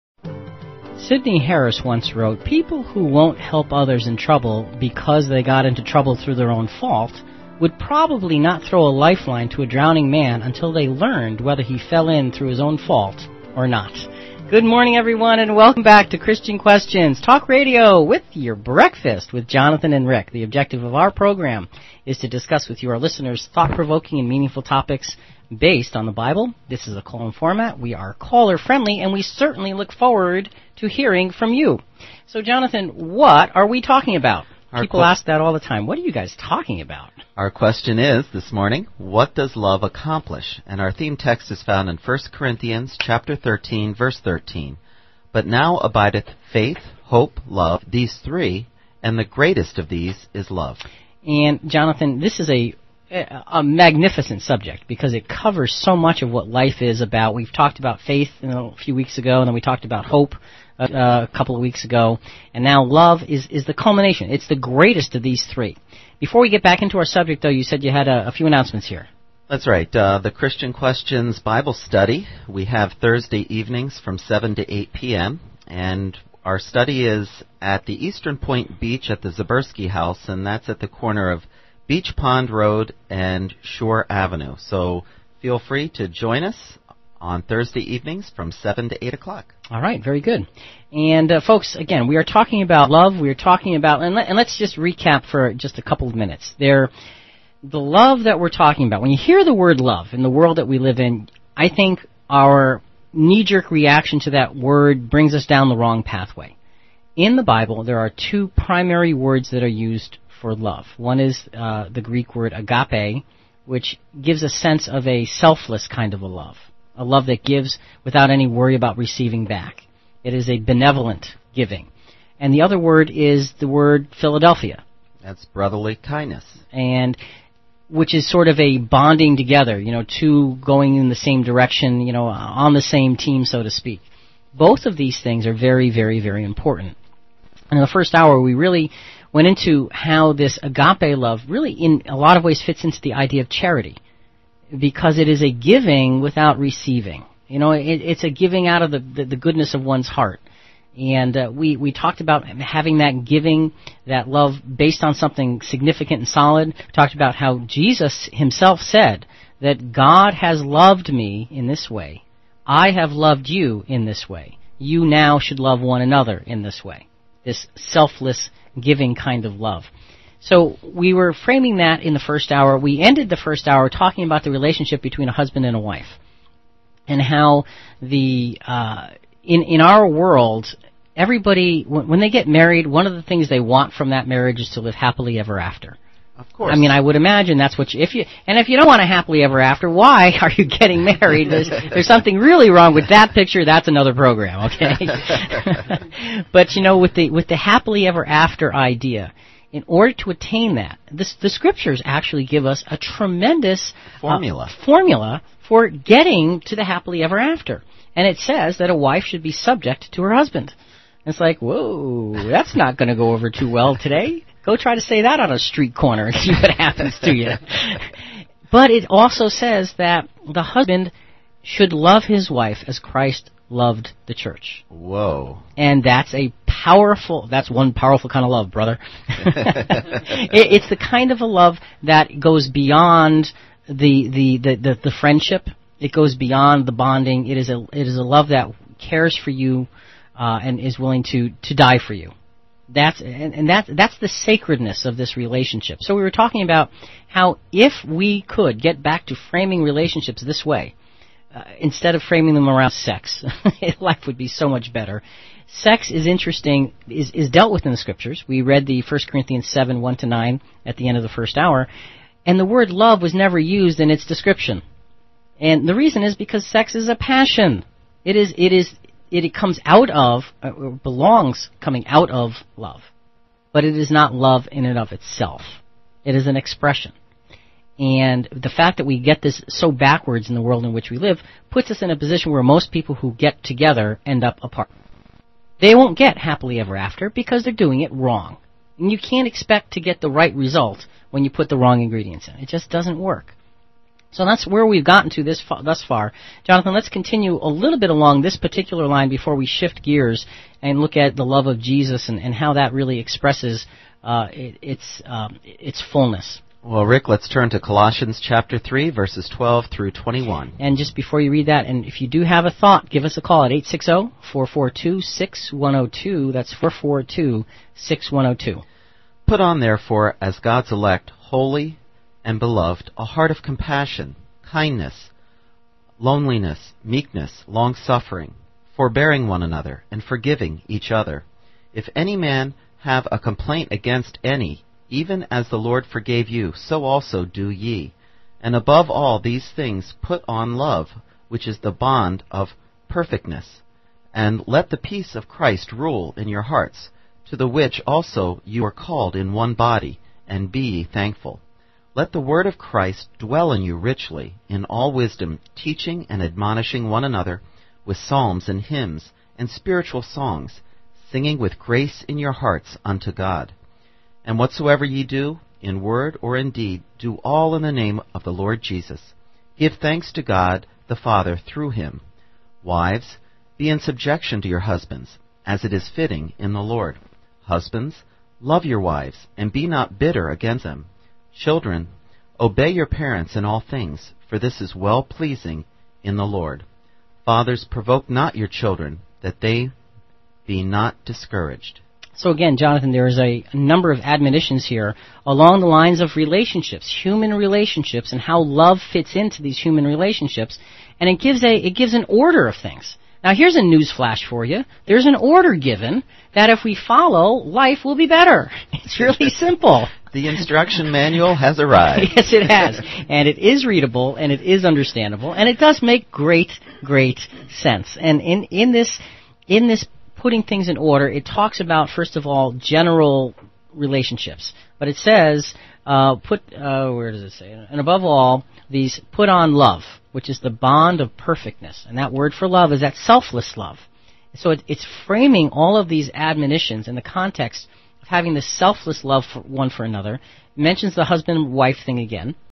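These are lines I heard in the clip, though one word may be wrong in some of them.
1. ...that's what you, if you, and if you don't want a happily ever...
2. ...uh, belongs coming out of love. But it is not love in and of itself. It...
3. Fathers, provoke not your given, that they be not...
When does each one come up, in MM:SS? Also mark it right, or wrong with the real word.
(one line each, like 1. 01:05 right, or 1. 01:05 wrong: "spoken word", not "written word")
1. 03:07 right
2. 04:30 right
3. 06:27 wrong: "children", not "given".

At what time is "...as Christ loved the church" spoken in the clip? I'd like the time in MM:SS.
03:42.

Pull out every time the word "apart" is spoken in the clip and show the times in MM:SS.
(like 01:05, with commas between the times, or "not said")
04:44.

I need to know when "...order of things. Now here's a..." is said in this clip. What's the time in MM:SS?
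06:42.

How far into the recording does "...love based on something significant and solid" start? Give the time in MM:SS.
02:34.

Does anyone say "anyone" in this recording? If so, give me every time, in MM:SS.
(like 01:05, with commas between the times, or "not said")
not said.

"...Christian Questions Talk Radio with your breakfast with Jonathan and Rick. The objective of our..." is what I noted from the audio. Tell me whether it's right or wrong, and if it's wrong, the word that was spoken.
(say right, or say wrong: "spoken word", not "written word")
right.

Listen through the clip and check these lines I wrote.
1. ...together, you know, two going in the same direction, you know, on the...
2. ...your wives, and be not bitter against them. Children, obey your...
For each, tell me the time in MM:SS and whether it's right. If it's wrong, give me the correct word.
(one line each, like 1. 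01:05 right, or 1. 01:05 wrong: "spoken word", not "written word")
1. 02:09 right
2. 06:18 right.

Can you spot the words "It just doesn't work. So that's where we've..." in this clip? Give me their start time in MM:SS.
04:52.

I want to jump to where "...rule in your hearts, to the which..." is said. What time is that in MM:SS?
05:45.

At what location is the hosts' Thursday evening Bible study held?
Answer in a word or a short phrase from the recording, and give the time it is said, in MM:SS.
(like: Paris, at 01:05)
Eastern Point Beach, at 01:18.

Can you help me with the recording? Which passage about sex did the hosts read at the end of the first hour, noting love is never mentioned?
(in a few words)
1 Corinthians 7:1-9.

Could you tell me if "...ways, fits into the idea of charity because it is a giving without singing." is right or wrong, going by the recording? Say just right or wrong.
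wrong.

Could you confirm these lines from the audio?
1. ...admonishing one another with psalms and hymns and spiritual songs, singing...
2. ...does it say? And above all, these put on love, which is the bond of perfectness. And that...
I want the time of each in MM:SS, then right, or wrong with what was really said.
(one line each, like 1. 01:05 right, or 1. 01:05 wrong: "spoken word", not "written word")
1. 05:56 right
2. 07:07 right.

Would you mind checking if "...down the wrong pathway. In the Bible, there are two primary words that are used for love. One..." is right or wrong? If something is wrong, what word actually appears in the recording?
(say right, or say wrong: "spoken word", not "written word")
right.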